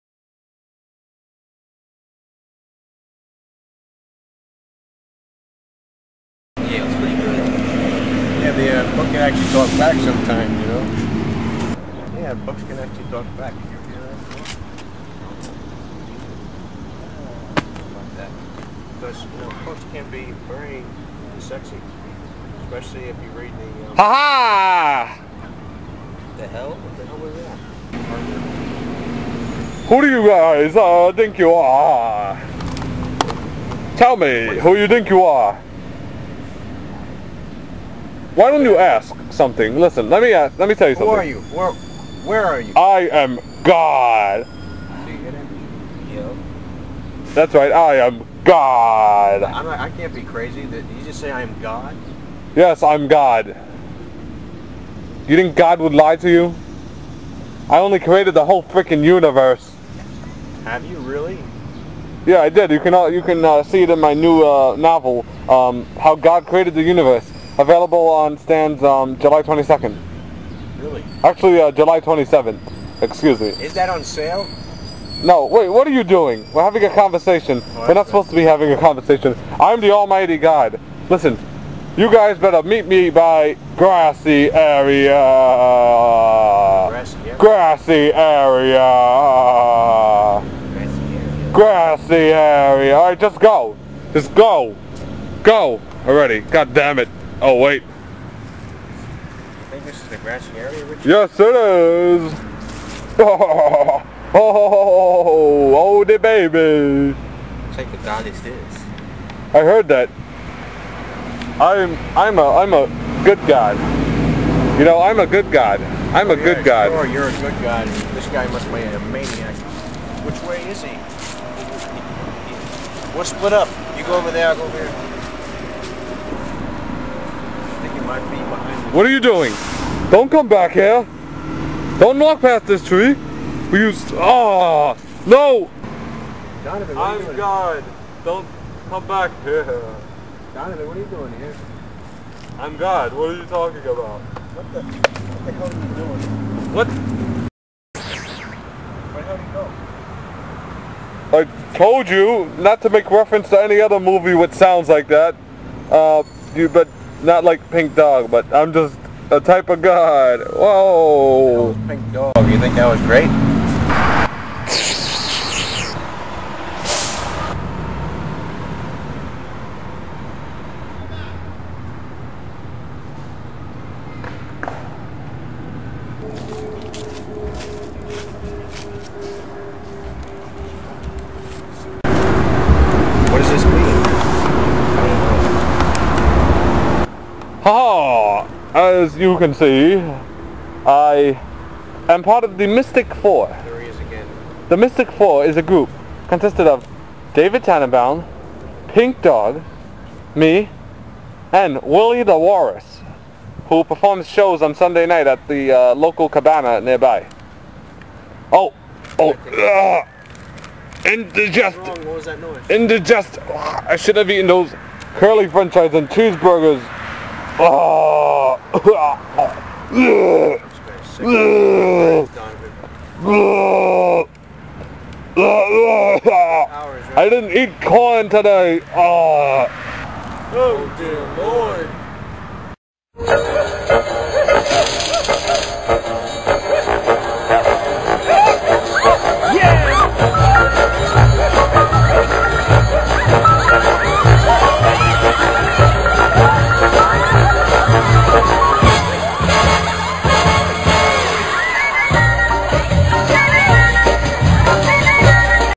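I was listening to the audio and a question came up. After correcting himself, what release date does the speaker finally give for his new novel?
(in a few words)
July 27th.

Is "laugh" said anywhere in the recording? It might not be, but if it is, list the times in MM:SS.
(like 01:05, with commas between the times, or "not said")
not said.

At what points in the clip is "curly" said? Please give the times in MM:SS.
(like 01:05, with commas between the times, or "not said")
03:35.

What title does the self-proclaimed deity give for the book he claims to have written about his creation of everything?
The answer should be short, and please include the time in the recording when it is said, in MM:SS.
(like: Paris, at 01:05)
How God Created the Universe, at 01:05.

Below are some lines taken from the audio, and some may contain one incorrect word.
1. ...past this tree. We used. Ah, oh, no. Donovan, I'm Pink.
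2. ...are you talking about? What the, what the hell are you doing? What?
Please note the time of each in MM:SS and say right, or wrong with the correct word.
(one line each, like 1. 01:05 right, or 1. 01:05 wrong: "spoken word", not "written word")
1. 02:12 wrong: "God", not "Pink"
2. 02:23 right.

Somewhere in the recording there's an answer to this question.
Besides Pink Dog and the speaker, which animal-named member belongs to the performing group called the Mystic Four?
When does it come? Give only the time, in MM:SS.
03:21.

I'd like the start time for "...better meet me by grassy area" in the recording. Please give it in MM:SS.
01:22.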